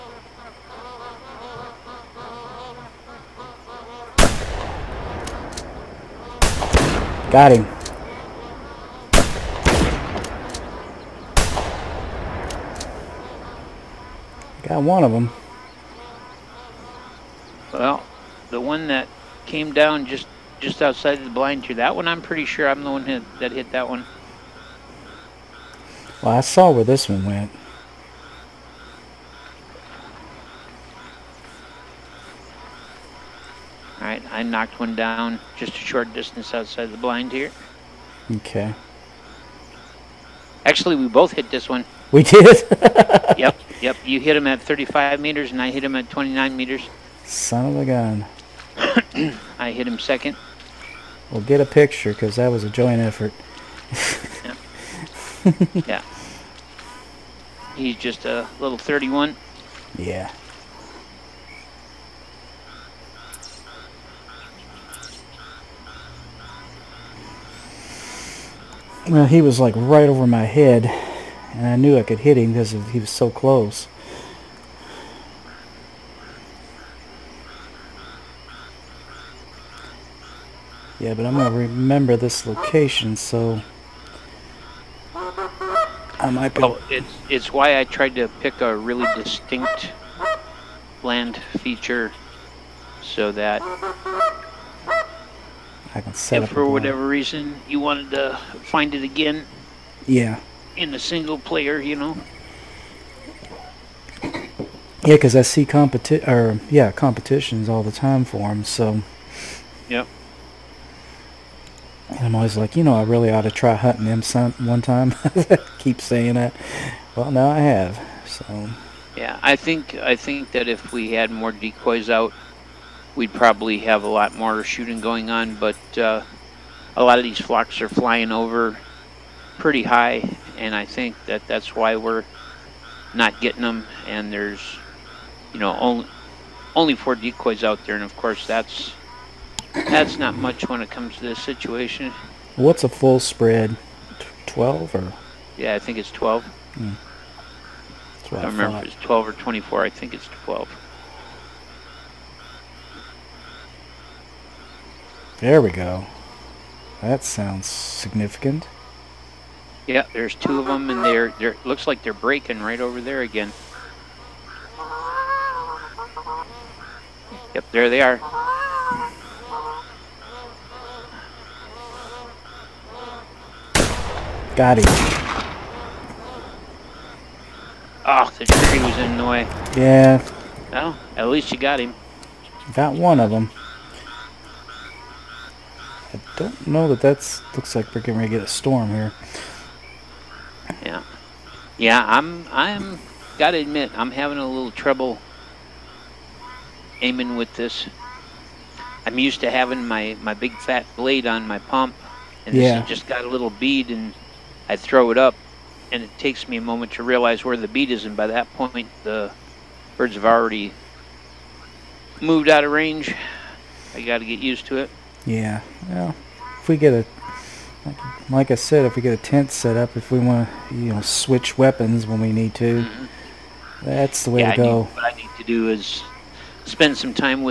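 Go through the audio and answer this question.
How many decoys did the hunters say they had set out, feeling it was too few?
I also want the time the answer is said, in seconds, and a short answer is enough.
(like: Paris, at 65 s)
4, at 136 s.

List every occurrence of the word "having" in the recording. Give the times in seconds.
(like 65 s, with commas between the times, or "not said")
194 s, 199 s.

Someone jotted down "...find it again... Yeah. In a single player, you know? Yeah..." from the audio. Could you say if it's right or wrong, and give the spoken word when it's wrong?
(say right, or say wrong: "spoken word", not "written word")
right.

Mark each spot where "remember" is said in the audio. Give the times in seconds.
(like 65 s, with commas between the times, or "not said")
81 s, 148 s.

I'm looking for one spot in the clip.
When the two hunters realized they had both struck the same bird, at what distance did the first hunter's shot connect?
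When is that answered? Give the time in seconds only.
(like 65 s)
44 s.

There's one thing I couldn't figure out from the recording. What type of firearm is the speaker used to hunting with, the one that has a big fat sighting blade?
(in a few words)
Pump.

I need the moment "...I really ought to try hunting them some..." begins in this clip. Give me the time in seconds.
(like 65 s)
112 s.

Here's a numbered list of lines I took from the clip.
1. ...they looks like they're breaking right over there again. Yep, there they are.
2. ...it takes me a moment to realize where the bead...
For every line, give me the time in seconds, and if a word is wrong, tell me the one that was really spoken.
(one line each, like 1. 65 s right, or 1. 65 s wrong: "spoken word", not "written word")
1. 161 s right
2. 206 s right.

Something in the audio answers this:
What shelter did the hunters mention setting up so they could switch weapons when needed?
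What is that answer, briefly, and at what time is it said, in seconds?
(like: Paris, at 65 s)
A tent, at 219 s.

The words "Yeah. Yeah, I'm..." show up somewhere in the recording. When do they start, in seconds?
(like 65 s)
190 s.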